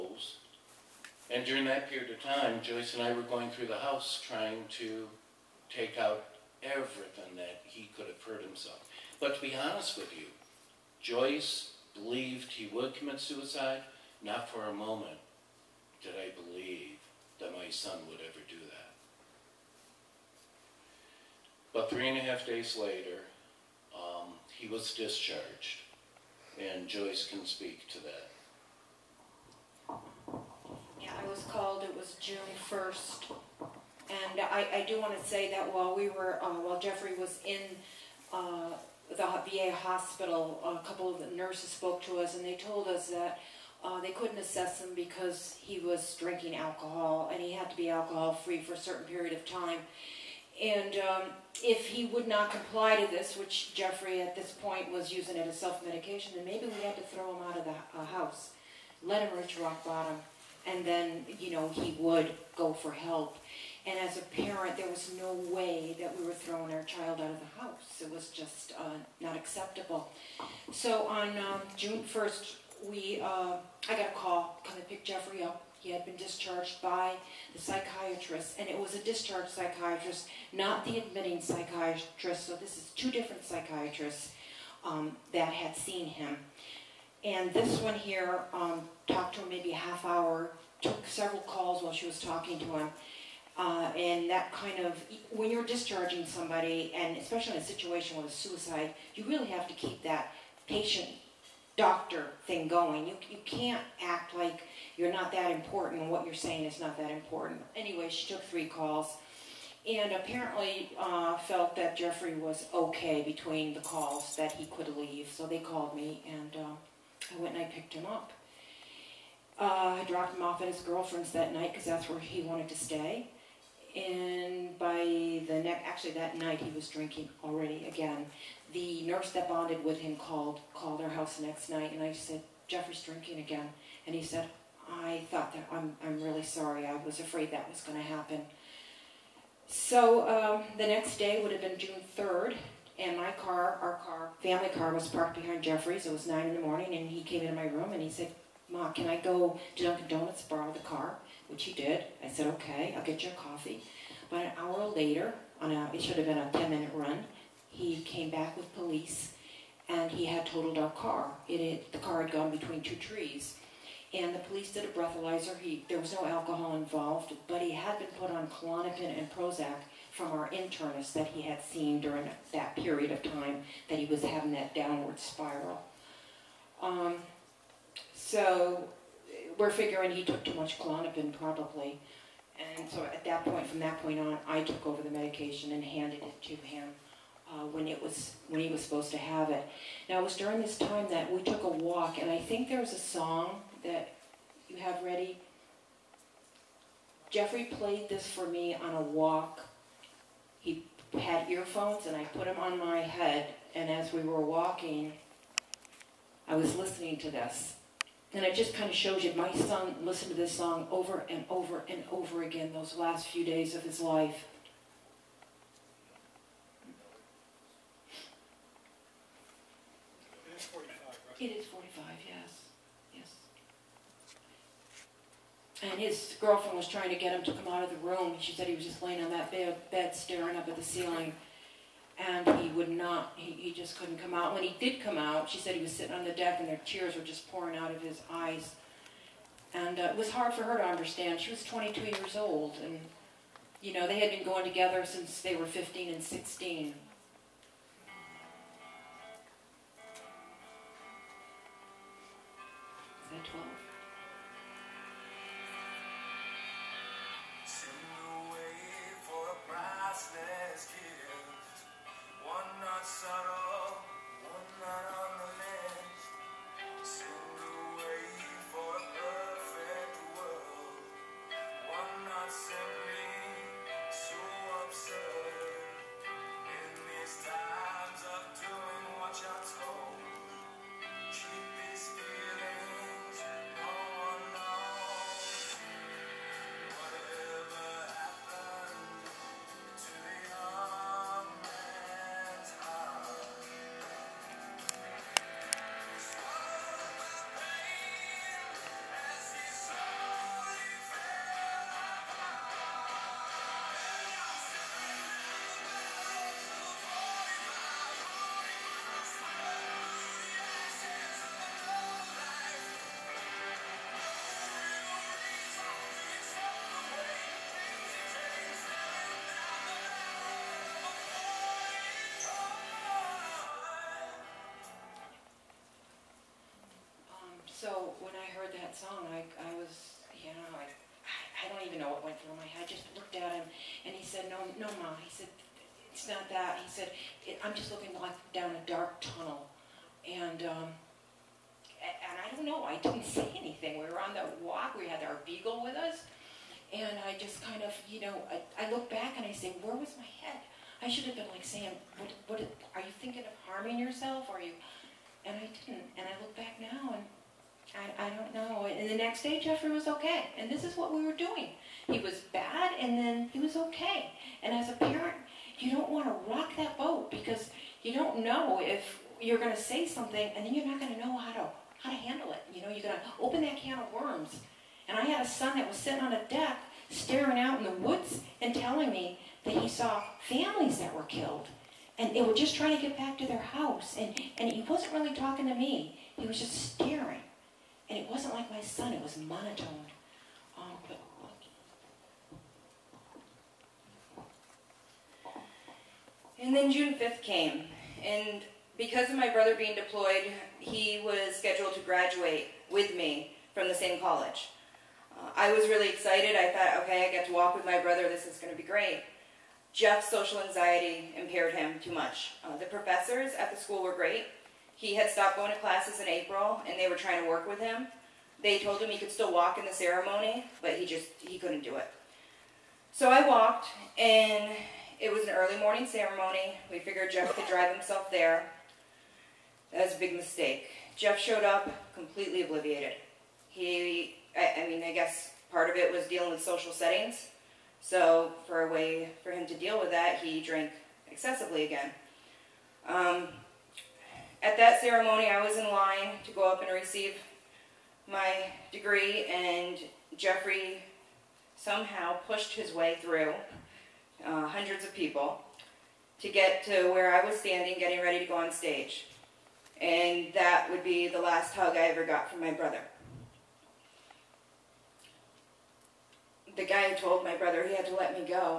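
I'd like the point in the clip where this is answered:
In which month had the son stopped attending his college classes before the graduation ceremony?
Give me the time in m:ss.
6:56.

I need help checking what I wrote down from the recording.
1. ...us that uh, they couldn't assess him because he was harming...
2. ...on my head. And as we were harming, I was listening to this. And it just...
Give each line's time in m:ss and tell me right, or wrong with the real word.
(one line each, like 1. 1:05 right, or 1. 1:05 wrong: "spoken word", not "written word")
1. 0:42 wrong: "drinking", not "harming"
2. 3:22 wrong: "walking", not "harming".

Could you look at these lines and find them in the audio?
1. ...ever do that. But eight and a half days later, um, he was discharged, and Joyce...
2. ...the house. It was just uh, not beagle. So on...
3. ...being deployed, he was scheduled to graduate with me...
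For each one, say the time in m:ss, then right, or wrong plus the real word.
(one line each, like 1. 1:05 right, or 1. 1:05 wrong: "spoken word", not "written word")
1. 0:18 wrong: "three", not "eight"
2. 1:07 wrong: "acceptable", not "beagle"
3. 6:39 right.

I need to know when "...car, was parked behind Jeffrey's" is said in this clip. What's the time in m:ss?
2:24.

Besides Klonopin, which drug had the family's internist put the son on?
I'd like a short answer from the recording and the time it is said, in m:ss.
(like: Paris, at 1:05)
Prozac, at 2:49.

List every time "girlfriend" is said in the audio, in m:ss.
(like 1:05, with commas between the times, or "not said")
2:00, 3:46.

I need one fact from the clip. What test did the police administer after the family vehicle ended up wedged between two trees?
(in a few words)
breathalyzer.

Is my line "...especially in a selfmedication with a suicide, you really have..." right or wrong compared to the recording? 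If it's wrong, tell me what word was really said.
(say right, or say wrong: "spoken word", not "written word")
wrong: "situation", not "selfmedication".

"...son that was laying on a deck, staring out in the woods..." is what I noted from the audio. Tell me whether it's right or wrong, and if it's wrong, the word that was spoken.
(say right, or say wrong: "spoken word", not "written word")
wrong: "sitting", not "laying".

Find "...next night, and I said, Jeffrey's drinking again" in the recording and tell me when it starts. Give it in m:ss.
2:11.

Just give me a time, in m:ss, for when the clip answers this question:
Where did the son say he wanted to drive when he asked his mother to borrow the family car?
2:29.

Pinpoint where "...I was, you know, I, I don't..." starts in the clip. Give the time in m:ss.
5:29.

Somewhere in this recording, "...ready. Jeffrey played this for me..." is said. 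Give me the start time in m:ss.
3:15.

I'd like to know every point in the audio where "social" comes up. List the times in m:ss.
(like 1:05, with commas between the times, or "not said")
6:50, 7:16.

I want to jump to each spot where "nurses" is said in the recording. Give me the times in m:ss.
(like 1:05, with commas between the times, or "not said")
0:41, 2:09.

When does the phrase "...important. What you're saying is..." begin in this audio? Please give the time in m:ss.
1:45.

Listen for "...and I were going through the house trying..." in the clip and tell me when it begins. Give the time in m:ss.
0:02.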